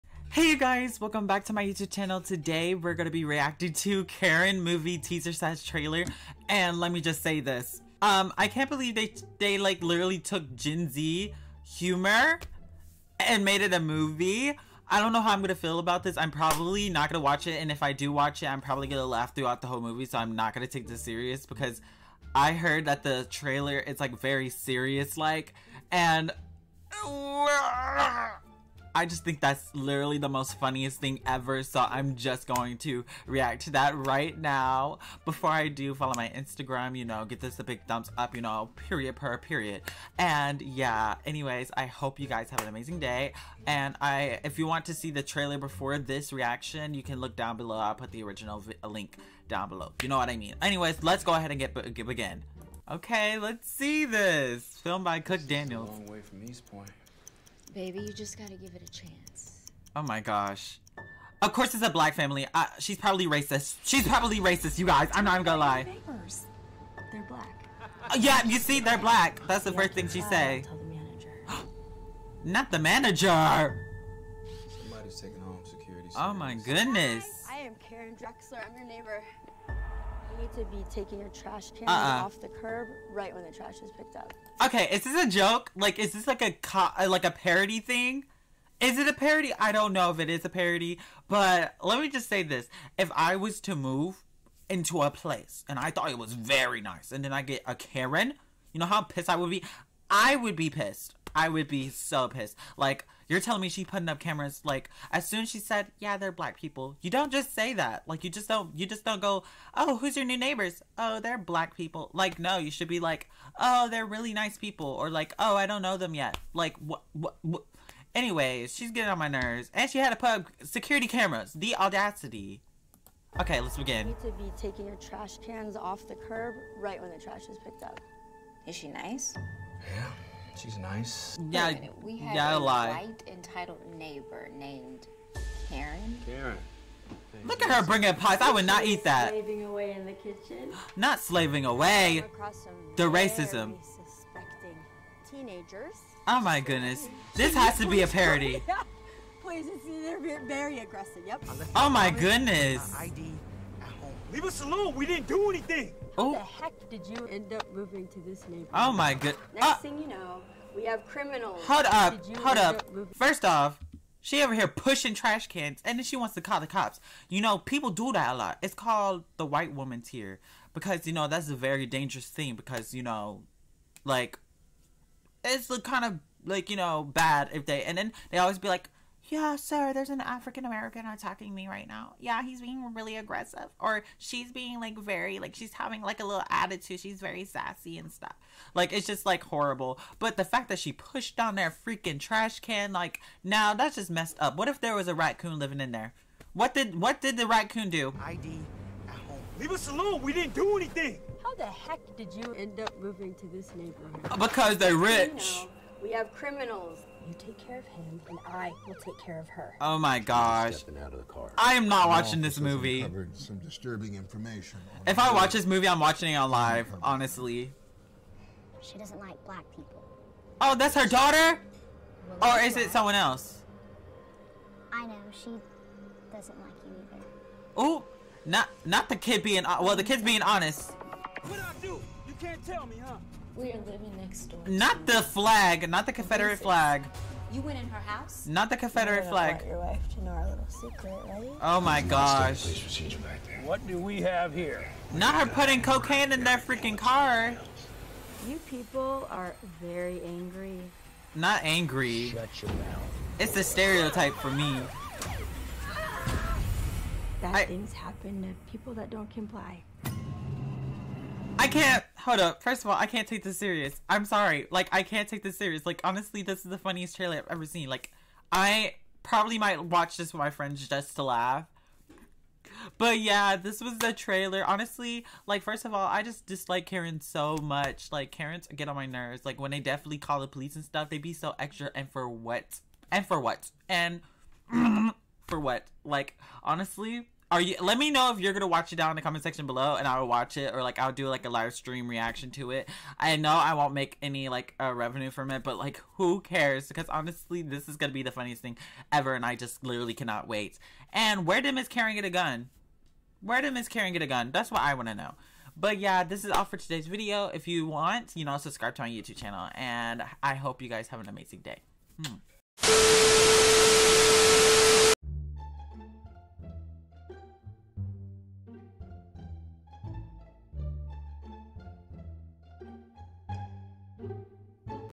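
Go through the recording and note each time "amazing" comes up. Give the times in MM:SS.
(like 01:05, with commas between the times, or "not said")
00:42, 05:11.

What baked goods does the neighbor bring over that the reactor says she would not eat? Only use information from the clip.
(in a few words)
Pies.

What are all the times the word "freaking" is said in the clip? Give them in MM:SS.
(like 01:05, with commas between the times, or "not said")
03:11, 04:06.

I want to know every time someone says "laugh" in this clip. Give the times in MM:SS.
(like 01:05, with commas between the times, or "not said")
00:19, 04:31.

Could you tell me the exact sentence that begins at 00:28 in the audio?
I just think that's literally the most funniest thing ever.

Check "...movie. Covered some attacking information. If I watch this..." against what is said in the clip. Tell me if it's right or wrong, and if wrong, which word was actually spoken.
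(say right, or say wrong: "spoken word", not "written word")
wrong: "disturbing", not "attacking".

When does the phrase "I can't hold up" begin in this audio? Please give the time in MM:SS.
04:21.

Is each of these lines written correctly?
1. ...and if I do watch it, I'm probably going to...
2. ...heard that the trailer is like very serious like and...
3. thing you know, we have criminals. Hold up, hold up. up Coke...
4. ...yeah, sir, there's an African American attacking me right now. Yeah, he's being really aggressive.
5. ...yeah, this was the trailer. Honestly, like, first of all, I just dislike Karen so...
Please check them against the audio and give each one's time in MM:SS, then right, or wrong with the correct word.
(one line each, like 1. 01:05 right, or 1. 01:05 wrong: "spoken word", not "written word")
1. 00:17 right
2. 00:22 right
3. 02:39 wrong: "First", not "Coke"
4. 02:59 right
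5. 04:33 right.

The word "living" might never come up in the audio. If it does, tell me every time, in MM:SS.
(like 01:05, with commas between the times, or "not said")
03:15, 03:53.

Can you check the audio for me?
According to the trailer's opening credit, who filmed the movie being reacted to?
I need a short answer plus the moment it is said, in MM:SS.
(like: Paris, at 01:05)
Coke Daniels, at 00:55.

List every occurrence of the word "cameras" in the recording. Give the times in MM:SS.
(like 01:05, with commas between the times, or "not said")
01:44, 02:01.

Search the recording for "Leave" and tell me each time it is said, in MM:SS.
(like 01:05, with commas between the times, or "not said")
02:34, 03:19.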